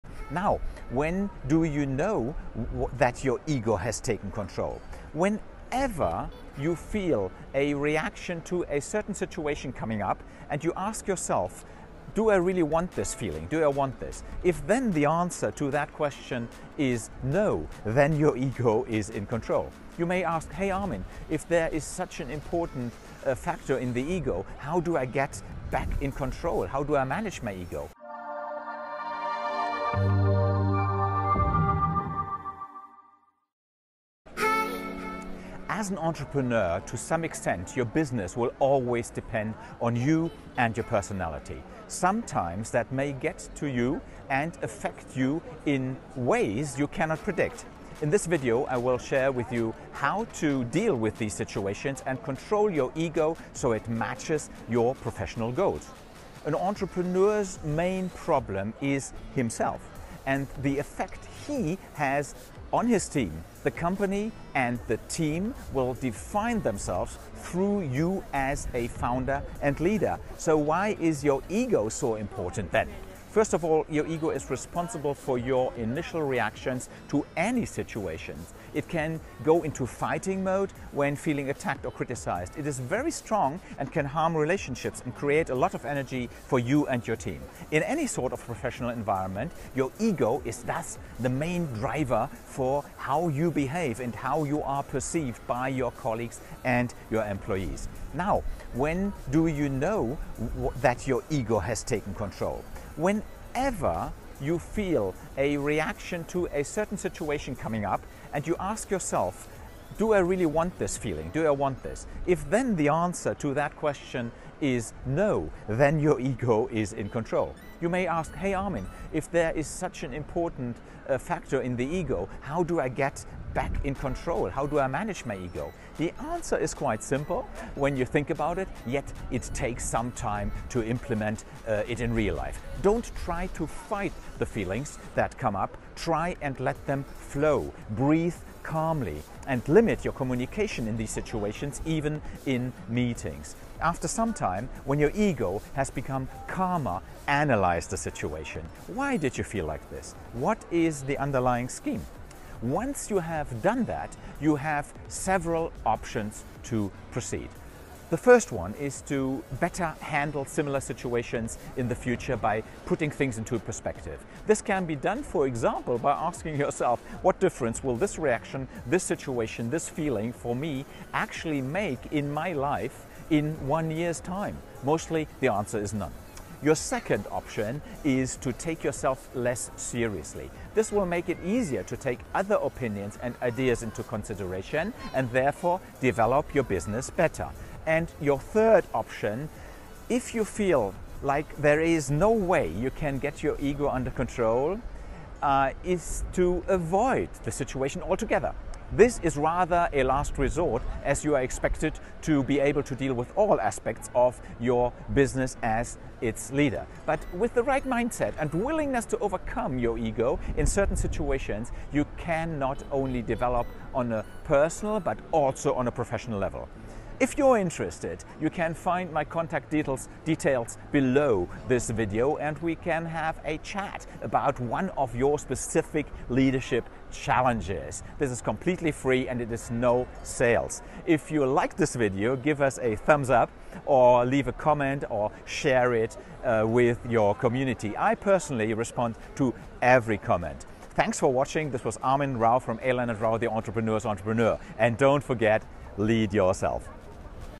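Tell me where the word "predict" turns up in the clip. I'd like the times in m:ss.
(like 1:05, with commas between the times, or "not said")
0:47.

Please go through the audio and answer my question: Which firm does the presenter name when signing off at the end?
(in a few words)
Alan and Rau.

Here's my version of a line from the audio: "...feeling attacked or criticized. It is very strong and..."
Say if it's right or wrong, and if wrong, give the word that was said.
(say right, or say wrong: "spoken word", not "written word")
right.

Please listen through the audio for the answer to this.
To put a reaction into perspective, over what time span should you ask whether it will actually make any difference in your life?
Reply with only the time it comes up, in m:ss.
2:53.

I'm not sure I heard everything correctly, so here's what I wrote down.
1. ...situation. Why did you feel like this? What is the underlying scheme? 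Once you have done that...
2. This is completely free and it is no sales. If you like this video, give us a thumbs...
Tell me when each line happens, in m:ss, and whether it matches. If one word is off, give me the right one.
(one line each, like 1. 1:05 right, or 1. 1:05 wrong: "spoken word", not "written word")
1. 2:27 right
2. 3:48 right.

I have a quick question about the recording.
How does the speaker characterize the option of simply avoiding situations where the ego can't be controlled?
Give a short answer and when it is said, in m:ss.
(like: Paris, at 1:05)
a last resort, at 3:20.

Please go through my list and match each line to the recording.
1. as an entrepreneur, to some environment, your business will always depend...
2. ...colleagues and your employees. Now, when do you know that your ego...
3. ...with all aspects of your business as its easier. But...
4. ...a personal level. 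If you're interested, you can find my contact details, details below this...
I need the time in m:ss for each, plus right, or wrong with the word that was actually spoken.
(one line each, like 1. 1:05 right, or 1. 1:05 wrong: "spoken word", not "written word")
1. 0:35 wrong: "extent", not "environment"
2. 1:35 right
3. 3:23 wrong: "leader", not "easier"
4. 3:35 wrong: "professional", not "personal".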